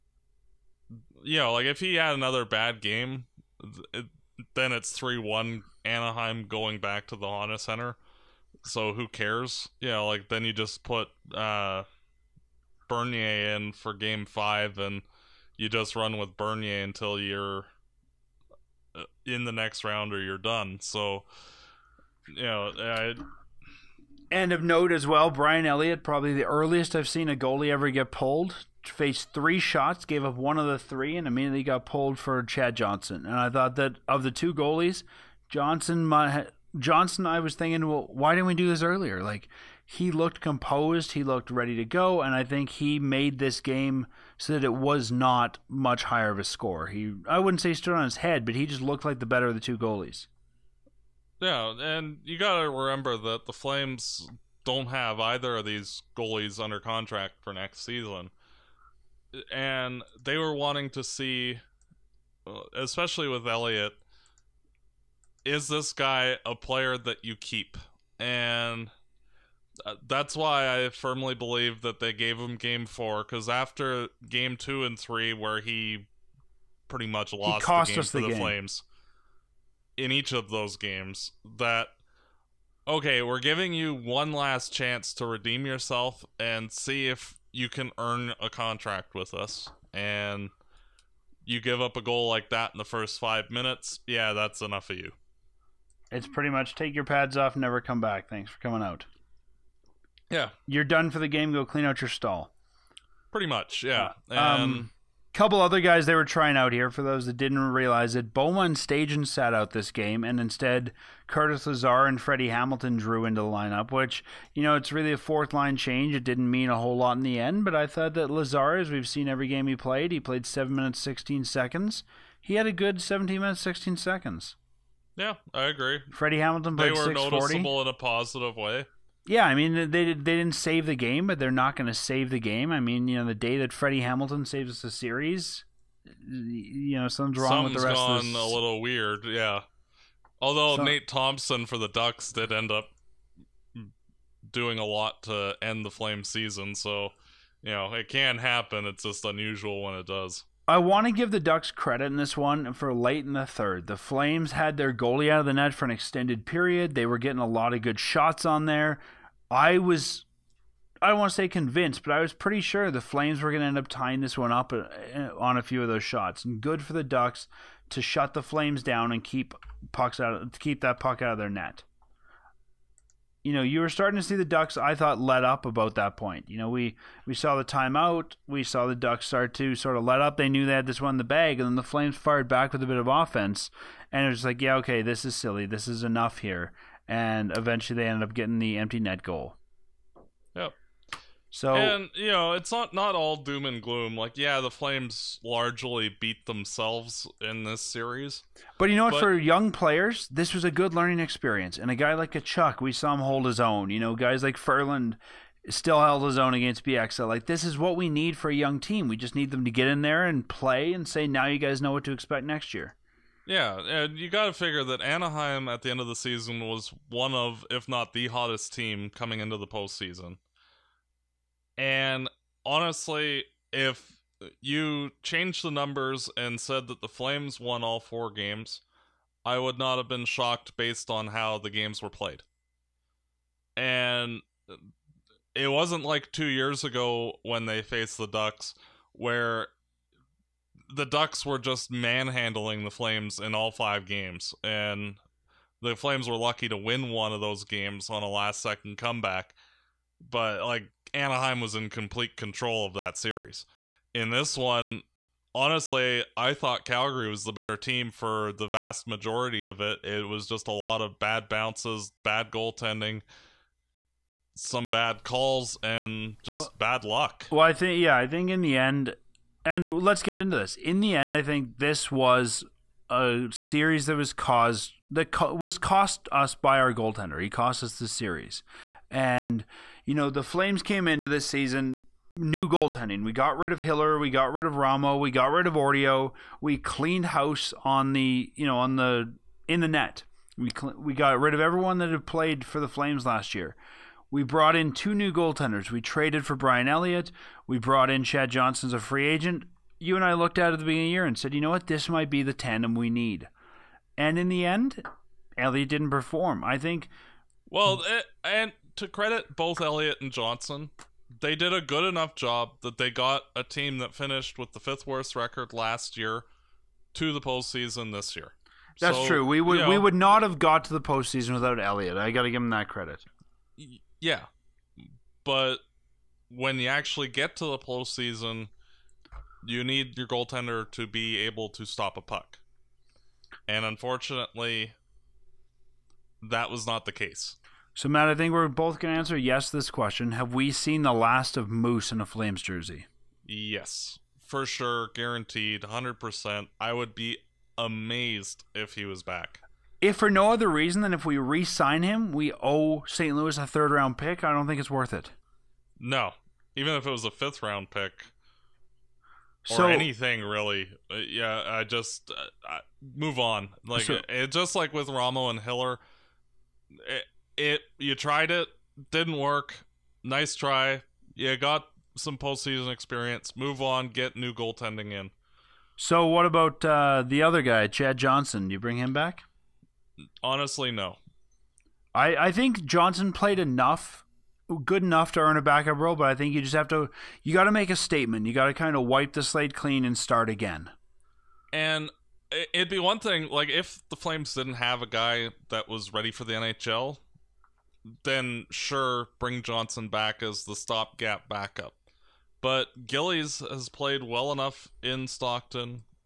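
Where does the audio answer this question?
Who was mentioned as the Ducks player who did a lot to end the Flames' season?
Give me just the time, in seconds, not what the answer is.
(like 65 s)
140 s.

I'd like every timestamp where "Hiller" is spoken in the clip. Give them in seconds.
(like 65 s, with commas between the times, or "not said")
283 s, 365 s.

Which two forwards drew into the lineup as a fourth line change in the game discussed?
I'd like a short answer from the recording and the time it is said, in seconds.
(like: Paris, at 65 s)
Curtis Lazar and Freddie Hamilton, at 111 s.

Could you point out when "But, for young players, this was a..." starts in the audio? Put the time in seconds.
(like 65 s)
199 s.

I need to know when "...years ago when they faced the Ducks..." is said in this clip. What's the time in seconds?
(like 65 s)
236 s.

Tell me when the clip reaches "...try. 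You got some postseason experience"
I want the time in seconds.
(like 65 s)
370 s.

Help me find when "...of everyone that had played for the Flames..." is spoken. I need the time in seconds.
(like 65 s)
291 s.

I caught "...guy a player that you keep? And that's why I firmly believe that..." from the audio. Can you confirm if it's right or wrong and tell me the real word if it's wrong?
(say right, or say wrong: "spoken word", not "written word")
right.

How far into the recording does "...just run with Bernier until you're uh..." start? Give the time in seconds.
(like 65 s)
15 s.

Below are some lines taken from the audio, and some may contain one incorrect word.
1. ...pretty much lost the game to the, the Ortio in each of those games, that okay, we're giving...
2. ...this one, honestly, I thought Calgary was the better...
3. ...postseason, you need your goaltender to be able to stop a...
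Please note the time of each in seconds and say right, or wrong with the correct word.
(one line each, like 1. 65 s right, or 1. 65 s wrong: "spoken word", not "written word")
1. 76 s wrong: "Flames", not "Ortio"
2. 254 s right
3. 327 s right.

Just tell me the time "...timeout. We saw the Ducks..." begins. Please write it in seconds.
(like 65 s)
177 s.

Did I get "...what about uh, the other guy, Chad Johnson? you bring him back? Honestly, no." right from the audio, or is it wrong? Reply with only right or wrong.
right.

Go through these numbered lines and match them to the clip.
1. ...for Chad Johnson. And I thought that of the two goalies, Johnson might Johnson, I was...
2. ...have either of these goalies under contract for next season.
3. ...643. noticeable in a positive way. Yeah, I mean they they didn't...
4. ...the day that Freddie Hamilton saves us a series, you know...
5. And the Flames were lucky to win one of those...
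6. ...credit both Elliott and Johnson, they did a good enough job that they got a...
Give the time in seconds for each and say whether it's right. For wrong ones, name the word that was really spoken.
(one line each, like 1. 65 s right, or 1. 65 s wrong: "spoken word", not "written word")
1. 32 s right
2. 54 s right
3. 127 s wrong: "640", not "643"
4. 133 s right
5. 244 s right
6. 309 s right.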